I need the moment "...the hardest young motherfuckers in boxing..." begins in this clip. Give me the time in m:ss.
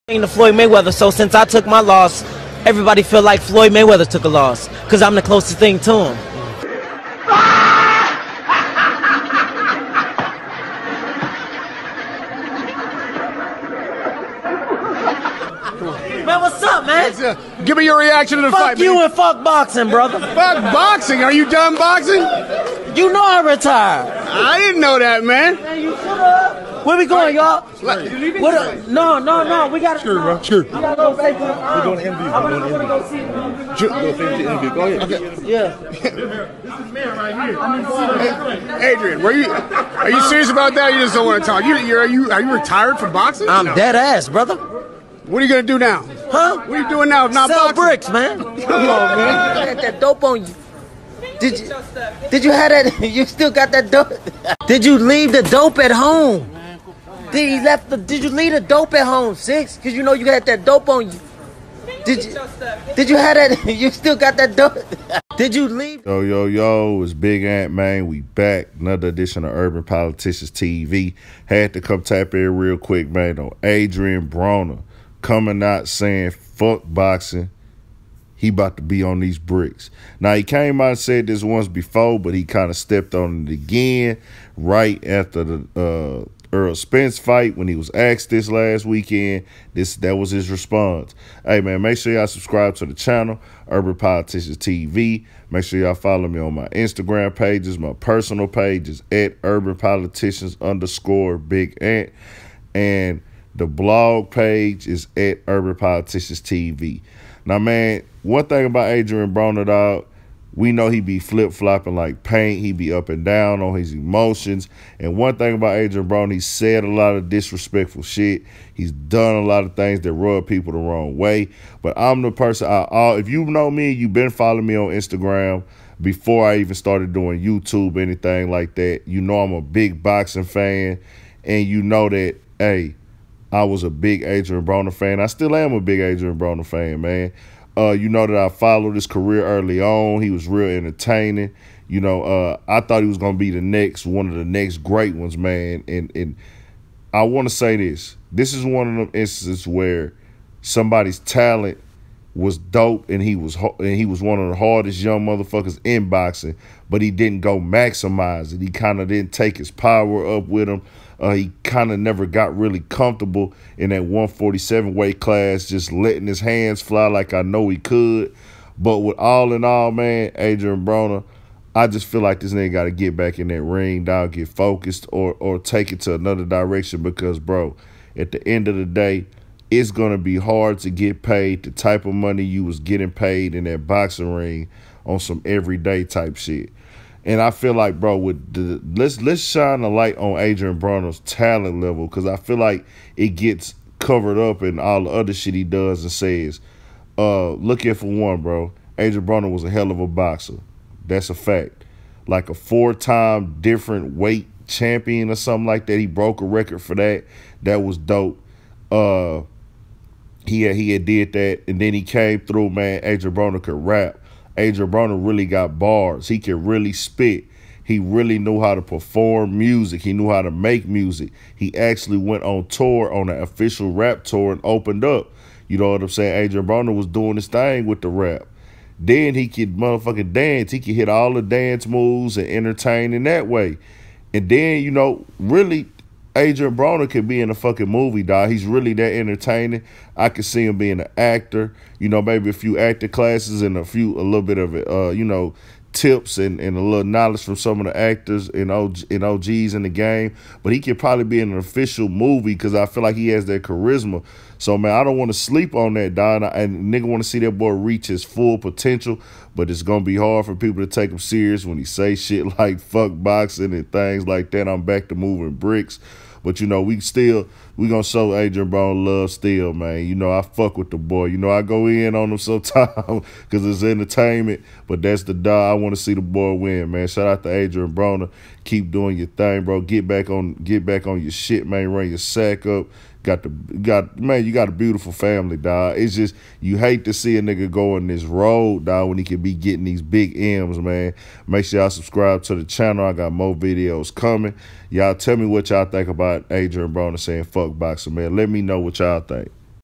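2:34.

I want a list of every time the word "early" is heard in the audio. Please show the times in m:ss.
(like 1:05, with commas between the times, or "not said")
2:19.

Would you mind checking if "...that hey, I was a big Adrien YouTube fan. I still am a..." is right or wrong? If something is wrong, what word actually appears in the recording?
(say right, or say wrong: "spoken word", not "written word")
wrong: "Broner", not "YouTube".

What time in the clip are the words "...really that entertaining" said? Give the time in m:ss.
3:58.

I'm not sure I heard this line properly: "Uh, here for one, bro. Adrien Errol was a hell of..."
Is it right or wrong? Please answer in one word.
wrong.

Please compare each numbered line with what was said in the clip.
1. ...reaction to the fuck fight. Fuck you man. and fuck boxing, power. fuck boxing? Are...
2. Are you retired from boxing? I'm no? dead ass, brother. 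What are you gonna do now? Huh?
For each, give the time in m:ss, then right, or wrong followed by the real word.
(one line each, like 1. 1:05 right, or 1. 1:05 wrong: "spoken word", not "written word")
1. 0:17 wrong: "brother", not "power"
2. 0:42 right.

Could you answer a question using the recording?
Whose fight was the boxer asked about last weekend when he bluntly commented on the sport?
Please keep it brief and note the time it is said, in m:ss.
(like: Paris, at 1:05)
Errol Spence, at 1:26.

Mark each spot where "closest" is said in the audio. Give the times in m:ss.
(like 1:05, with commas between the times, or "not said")
0:05.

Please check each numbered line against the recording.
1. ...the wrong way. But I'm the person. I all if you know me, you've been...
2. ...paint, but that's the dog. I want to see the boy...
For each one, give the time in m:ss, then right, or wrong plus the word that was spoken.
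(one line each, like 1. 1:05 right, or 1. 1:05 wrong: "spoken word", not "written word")
1. 2:00 right
2. 4:33 wrong: "entertainment", not "paint".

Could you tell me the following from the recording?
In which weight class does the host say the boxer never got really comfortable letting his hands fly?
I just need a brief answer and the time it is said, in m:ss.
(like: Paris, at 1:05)
147, at 2:44.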